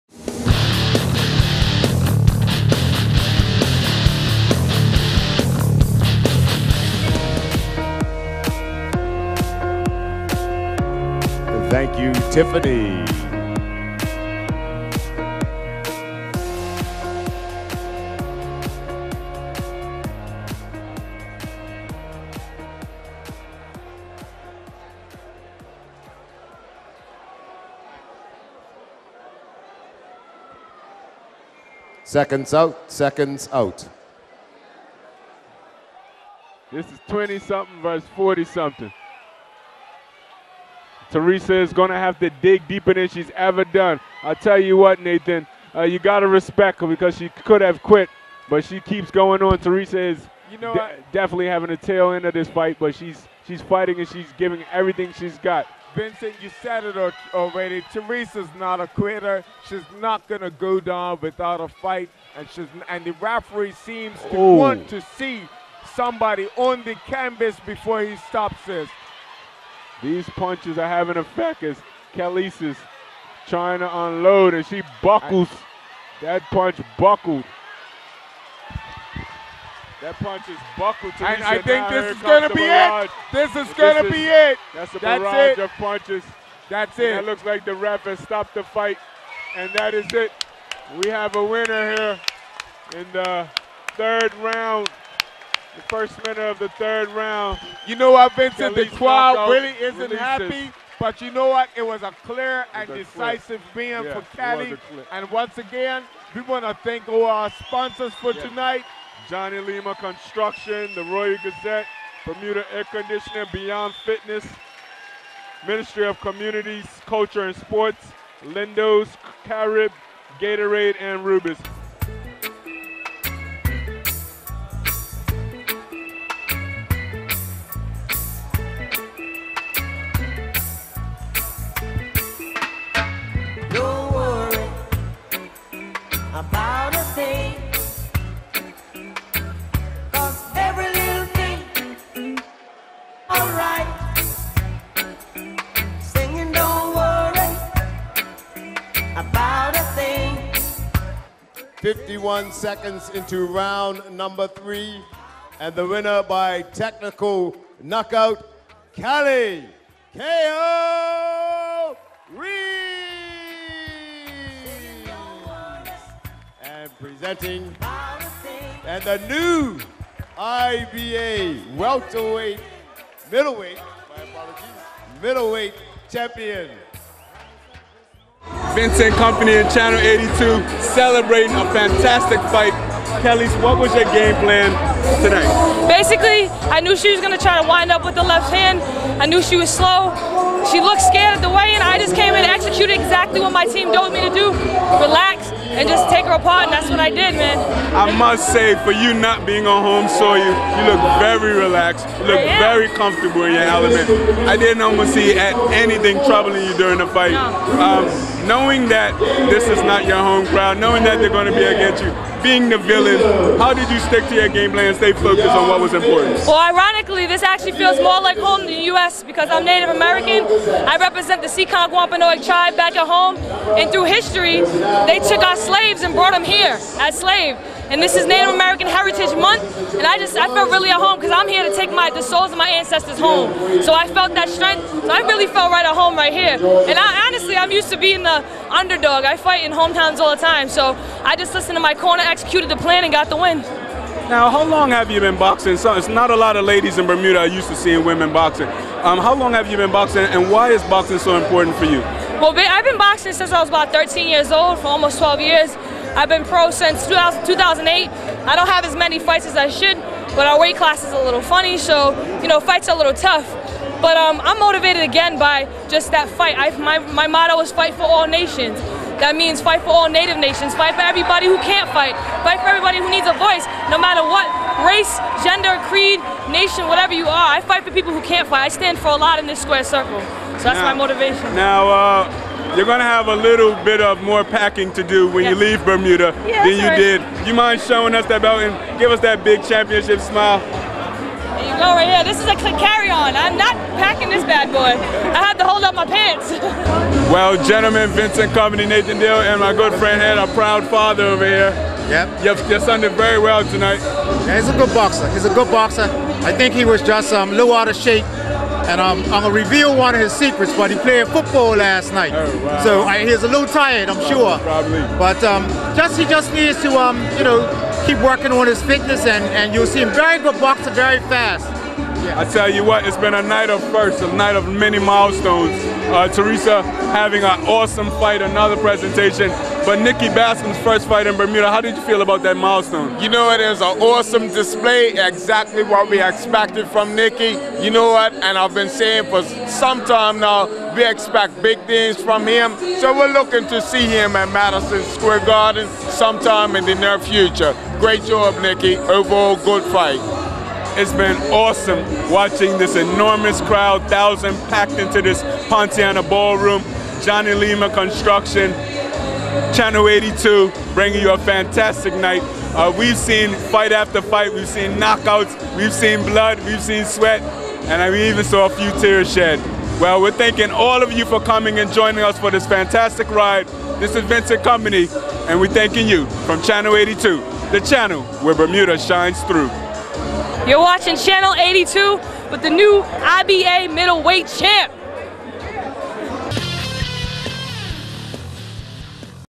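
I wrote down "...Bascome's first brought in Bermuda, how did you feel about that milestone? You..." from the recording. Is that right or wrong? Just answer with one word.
wrong.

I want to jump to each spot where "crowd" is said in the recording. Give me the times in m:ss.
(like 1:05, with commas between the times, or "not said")
1:38, 3:30, 5:53.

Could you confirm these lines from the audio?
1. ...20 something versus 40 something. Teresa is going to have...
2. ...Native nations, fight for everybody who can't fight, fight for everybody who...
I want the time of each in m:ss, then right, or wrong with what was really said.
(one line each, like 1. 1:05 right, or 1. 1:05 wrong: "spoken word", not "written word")
1. 0:37 right
2. 4:30 right.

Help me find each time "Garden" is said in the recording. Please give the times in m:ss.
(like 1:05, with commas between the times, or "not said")
5:45.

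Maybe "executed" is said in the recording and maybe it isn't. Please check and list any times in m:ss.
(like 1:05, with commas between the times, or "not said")
3:12, 4:02.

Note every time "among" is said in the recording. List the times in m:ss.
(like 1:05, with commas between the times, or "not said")
not said.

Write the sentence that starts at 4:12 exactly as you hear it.
Well, I've been boxing since I was about 13 years old for almost 12 years.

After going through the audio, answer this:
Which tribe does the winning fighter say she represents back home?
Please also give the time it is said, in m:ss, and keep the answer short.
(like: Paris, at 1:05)
Seekonk Wampanoag, at 3:41.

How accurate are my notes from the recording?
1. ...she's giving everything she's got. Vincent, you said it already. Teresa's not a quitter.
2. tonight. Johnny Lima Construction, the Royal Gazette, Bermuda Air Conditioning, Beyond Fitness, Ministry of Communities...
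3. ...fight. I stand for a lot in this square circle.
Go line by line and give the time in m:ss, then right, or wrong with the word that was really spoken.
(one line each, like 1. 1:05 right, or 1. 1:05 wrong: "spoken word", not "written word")
1. 0:54 right
2. 1:48 right
3. 4:38 right.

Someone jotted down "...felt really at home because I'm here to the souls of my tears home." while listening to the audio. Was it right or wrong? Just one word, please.
wrong.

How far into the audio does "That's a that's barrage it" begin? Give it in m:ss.
1:24.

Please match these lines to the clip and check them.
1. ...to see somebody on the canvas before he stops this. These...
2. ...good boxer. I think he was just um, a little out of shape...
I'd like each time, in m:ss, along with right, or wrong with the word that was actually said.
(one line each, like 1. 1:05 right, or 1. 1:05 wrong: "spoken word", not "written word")
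1. 1:04 right
2. 5:05 right.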